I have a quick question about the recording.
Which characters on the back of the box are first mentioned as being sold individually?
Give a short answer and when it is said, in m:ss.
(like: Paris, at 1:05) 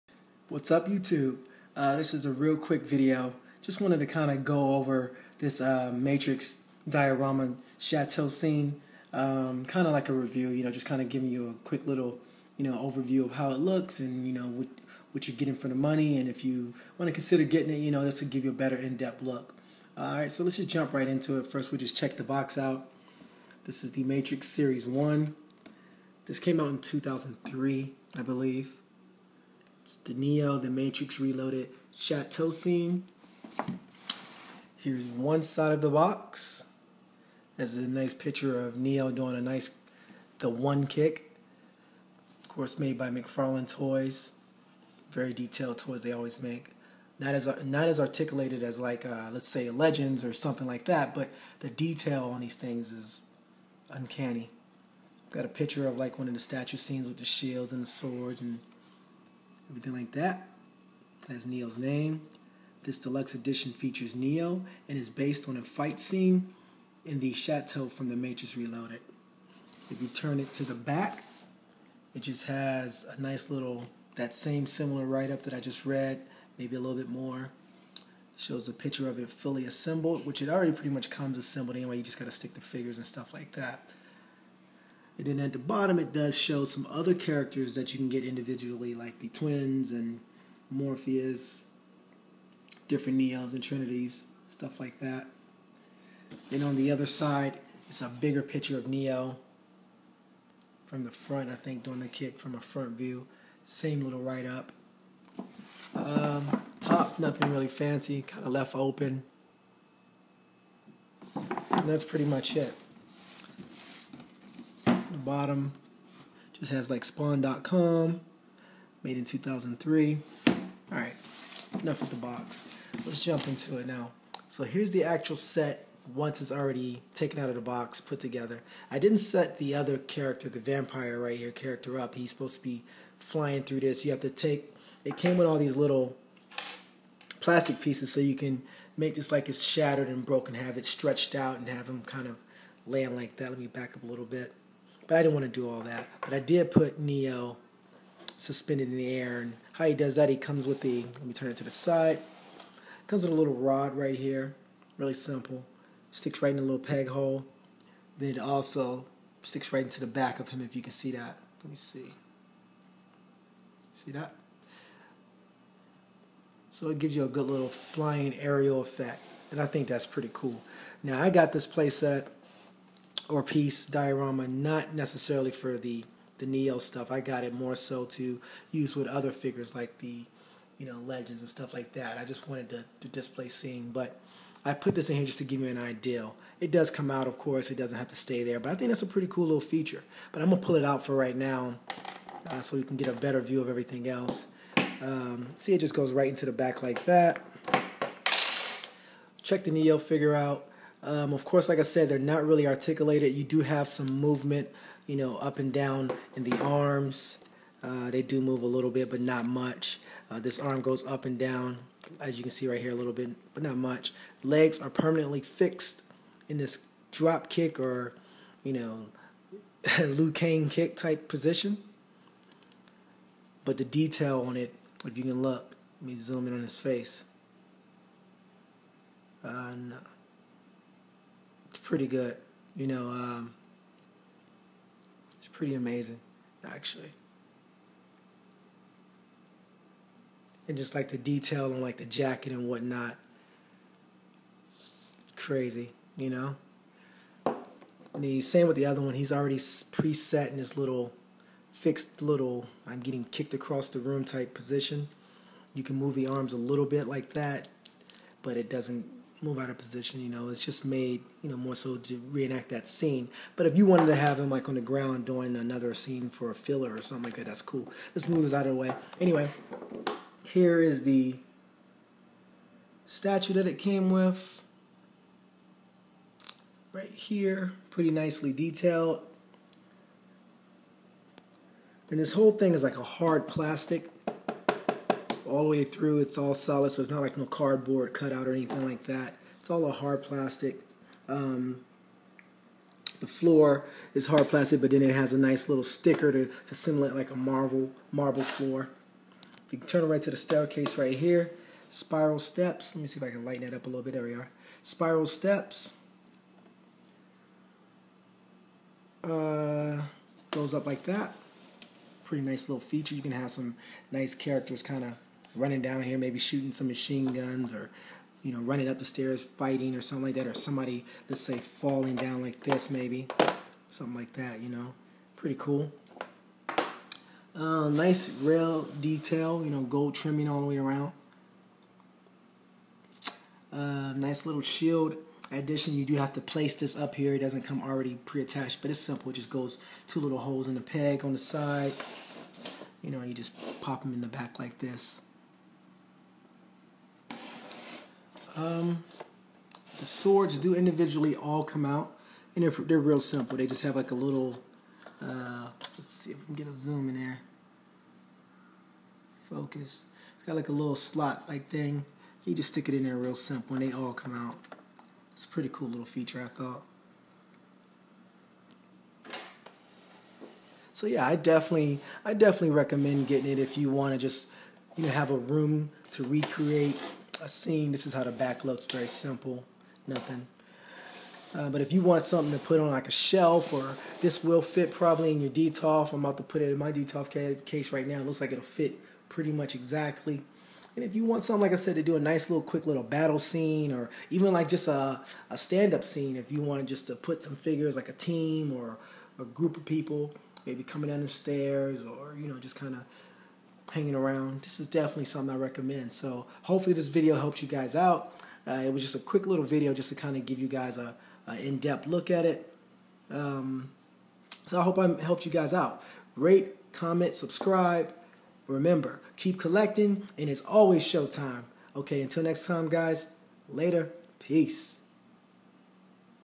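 The twins, at 1:29.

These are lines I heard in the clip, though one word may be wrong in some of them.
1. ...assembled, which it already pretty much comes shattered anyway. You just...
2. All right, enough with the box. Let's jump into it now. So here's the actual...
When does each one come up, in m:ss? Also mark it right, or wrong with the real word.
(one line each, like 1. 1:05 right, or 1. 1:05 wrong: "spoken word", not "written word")
1. 1:19 wrong: "assembled", not "shattered"
2. 2:00 right.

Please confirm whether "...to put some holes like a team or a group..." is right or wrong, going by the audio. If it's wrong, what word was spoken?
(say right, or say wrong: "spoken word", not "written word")
wrong: "figures", not "holes".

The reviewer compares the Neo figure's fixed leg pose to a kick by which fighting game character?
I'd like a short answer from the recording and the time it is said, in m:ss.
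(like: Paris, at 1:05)
Liu Kang, at 3:39.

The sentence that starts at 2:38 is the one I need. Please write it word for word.
Then it also sticks right into the back of him, if you can see that.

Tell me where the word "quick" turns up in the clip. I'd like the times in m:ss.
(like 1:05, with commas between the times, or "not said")
0:02, 0:11, 6:32, 6:49.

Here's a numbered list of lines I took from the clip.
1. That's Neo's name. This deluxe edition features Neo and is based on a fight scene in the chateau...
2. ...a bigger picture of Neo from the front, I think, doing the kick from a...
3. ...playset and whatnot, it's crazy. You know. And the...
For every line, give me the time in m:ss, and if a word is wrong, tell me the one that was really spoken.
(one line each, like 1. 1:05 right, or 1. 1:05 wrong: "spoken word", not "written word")
1. 1:01 right
2. 1:38 right
3. 4:02 wrong: "jacket", not "playset".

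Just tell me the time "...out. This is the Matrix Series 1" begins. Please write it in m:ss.
0:22.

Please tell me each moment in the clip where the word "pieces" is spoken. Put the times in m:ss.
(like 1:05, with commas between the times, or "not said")
2:17, 2:53.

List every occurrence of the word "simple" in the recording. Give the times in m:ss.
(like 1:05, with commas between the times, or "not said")
2:35, 5:39, 5:53, 6:03, 6:19.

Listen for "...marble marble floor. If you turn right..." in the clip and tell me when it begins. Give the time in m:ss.
4:57.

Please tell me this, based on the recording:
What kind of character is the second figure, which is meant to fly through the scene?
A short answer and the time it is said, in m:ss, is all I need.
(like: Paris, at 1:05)
vampire, at 2:10.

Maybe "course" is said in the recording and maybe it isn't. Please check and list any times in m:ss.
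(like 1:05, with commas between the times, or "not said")
0:42, 3:07, 3:21.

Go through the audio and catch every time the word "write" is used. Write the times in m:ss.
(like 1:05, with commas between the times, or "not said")
1:15, 1:44.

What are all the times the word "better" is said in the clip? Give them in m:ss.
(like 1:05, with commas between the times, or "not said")
0:18, 3:13.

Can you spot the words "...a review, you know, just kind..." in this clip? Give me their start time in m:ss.
0:10.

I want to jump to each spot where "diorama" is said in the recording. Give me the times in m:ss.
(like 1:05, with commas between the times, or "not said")
0:06, 2:53.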